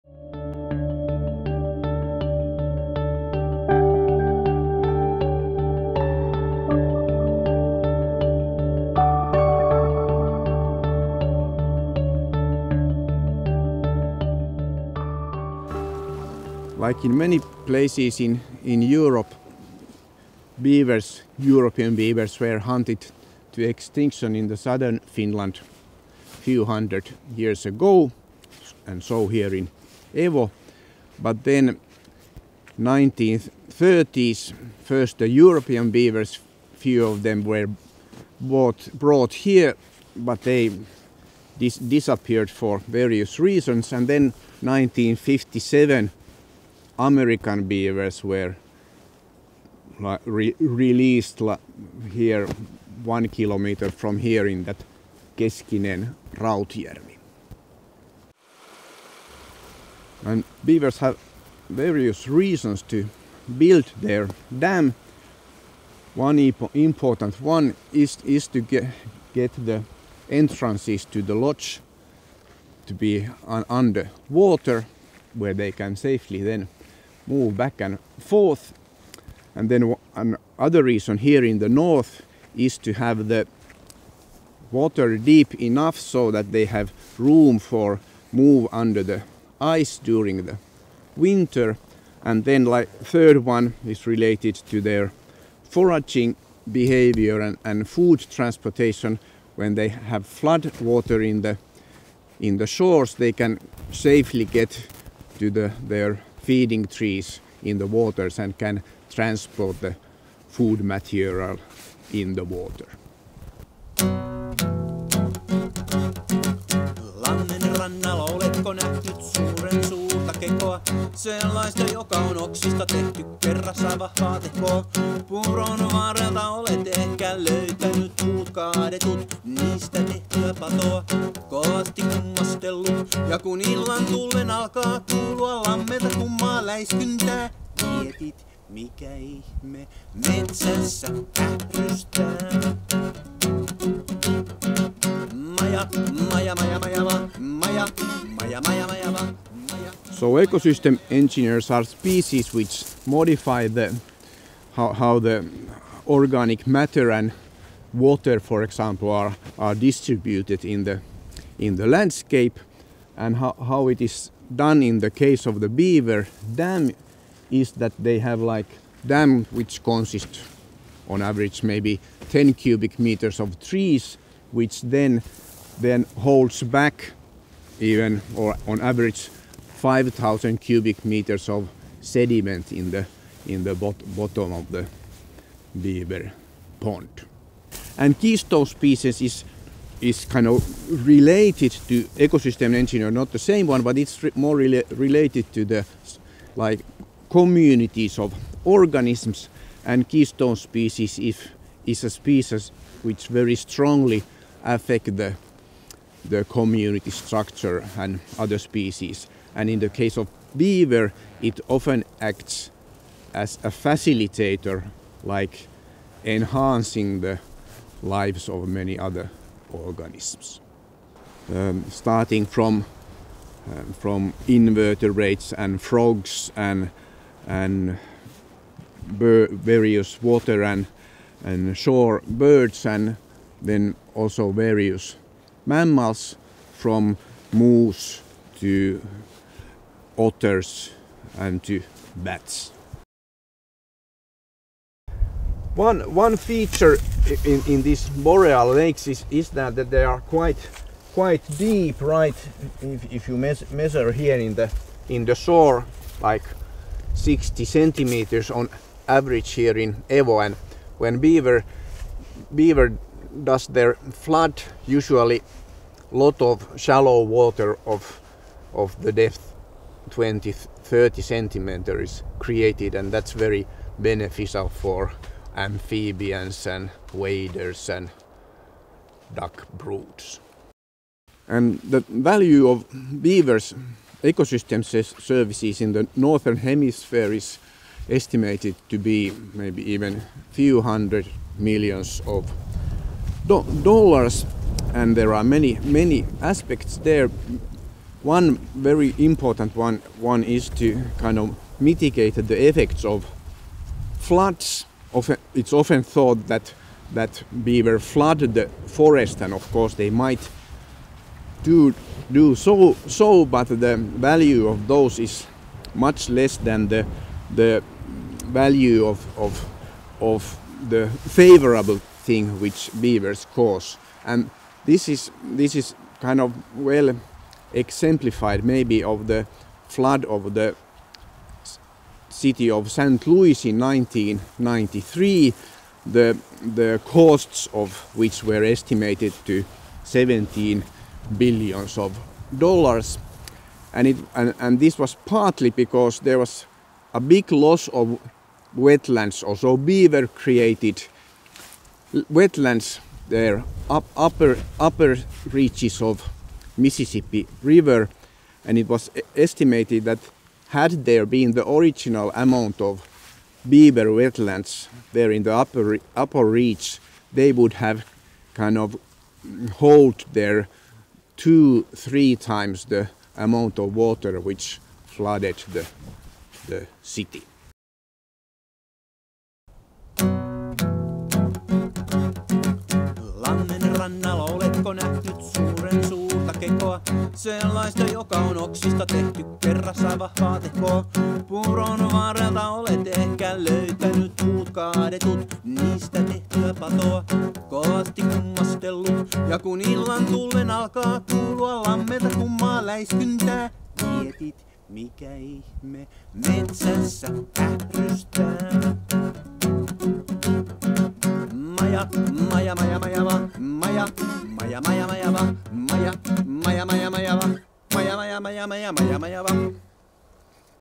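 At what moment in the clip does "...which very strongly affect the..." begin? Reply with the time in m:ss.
3:23.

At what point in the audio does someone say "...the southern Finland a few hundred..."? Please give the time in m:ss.
0:24.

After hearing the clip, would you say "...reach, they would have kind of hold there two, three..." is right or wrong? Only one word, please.
right.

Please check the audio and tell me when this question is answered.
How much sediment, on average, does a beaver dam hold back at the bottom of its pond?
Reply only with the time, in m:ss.
2:59.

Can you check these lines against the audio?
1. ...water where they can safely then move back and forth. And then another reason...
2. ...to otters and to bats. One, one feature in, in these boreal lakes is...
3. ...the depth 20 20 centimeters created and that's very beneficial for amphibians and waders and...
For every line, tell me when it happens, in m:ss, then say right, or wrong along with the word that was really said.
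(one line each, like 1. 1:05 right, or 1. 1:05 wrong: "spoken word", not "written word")
1. 1:14 right
2. 3:58 right
3. 4:29 wrong: "30", not "20".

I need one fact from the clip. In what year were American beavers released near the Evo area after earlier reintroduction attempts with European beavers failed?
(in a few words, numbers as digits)
1957.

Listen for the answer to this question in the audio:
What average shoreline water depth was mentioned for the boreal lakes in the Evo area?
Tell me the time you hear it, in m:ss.
4:17.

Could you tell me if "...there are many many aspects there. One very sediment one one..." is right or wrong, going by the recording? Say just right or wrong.
wrong.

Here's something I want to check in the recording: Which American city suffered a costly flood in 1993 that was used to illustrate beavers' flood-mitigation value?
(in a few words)
St. Louis.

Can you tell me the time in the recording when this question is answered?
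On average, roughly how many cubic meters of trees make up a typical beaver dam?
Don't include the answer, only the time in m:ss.
2:52.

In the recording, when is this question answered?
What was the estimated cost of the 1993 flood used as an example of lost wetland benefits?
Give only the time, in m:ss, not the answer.
5:40.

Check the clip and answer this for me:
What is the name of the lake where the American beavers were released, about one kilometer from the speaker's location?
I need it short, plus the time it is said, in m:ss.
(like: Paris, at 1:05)
Keskinen Rautjärvi, at 0:55.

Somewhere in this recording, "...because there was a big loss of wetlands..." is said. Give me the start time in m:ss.
5:45.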